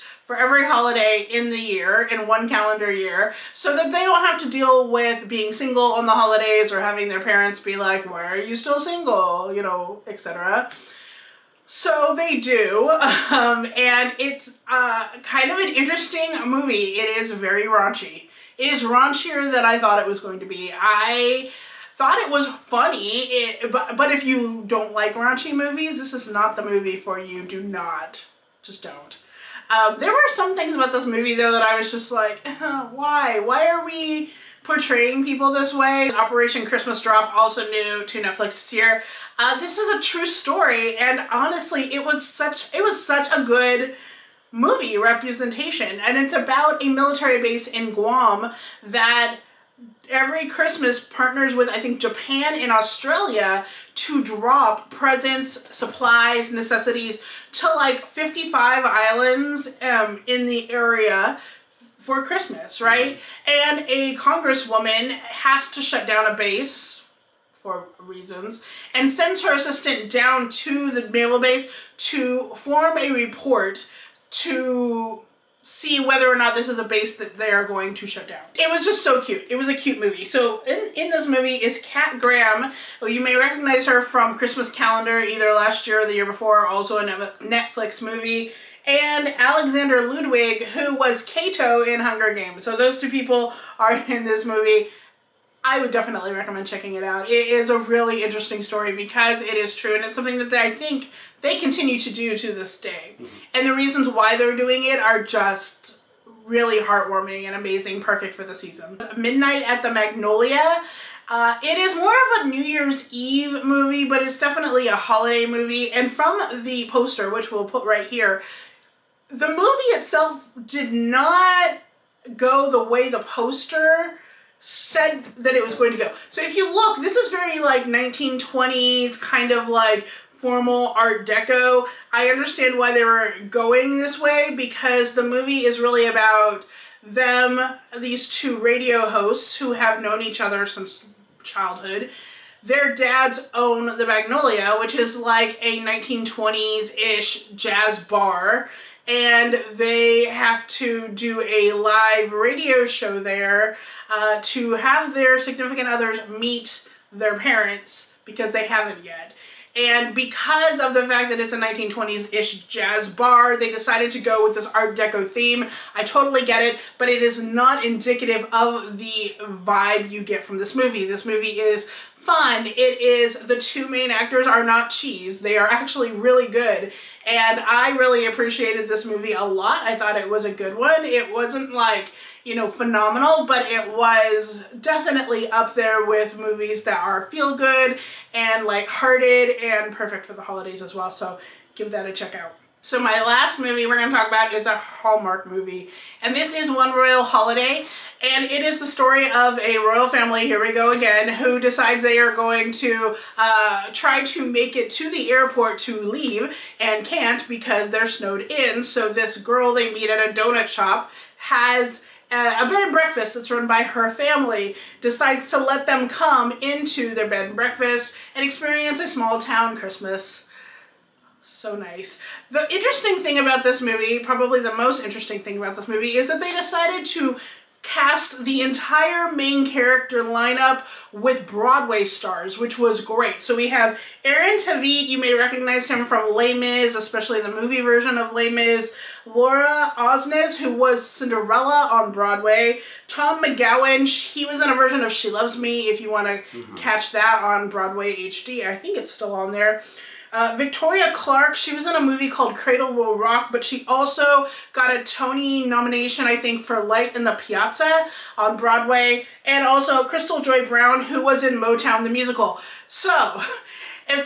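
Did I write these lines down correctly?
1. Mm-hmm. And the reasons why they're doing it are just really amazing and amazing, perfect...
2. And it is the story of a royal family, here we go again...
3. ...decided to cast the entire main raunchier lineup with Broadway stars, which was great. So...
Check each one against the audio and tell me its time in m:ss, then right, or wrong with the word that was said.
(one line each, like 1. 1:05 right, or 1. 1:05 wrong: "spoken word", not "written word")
1. 1:43 wrong: "heartwarming", not "amazing"
2. 3:18 right
3. 3:46 wrong: "character", not "raunchier".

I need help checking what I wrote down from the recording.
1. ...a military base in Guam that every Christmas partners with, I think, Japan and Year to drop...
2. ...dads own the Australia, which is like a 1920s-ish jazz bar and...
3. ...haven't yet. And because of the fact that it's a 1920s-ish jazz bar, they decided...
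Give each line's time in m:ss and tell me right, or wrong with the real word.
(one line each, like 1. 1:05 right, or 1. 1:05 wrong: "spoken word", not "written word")
1. 0:46 wrong: "Australia", not "Year"
2. 2:22 wrong: "Magnolia", not "Australia"
3. 2:38 right.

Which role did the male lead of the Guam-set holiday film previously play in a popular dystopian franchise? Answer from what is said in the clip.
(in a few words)
Cato.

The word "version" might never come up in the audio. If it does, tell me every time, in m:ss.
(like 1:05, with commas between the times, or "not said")
3:57, 4:04.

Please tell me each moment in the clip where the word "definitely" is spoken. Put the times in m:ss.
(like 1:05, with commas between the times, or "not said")
1:35, 1:54, 3:04.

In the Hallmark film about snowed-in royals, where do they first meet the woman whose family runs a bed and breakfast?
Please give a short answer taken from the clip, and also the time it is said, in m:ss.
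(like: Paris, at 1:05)
a donut shop, at 3:30.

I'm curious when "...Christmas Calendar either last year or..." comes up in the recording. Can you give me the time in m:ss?
1:24.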